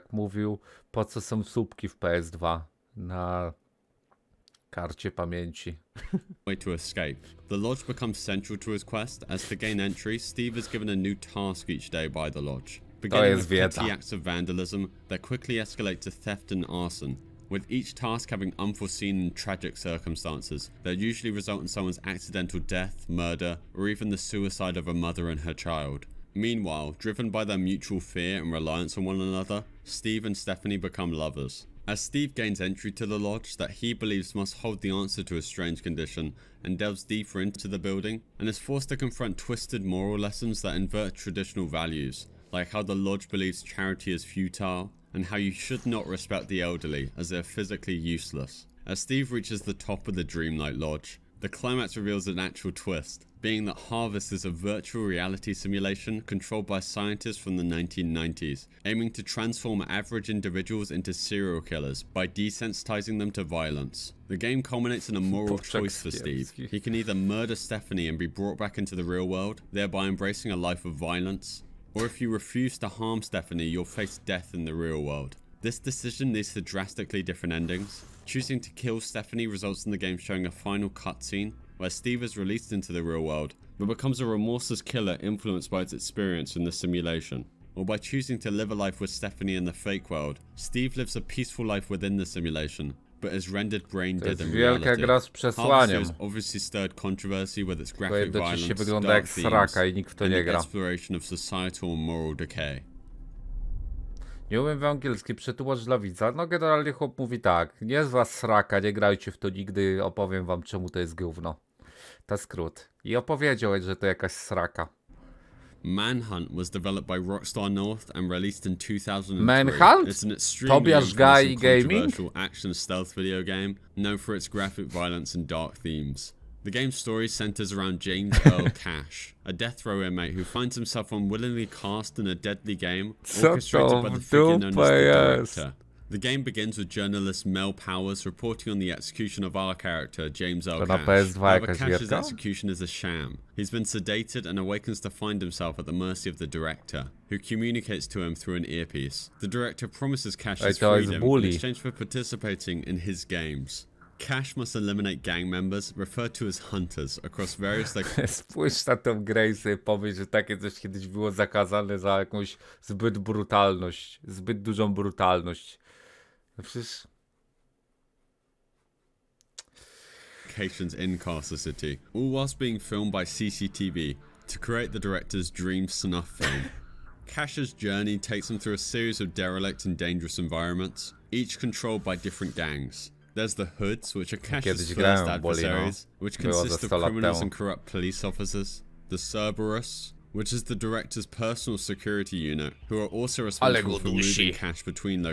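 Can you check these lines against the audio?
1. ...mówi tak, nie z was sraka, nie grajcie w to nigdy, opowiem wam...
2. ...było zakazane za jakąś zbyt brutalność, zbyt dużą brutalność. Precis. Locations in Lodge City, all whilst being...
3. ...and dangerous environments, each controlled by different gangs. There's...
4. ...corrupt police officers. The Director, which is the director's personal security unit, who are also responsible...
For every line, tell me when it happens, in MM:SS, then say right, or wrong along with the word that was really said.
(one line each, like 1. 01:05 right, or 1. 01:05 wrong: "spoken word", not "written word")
1. 01:47 right
2. 02:41 wrong: "Carcer", not "Lodge"
3. 02:59 right
4. 03:07 wrong: "Cerberus", not "Director".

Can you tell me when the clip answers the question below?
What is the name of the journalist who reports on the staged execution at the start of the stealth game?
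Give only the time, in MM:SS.
02:17.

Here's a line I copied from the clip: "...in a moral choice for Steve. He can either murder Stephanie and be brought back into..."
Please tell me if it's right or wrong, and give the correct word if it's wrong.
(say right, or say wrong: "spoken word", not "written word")
right.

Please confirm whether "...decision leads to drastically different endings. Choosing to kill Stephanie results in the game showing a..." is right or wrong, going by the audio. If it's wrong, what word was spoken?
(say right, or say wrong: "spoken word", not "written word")
right.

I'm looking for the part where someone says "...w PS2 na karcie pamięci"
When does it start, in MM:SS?
00:01.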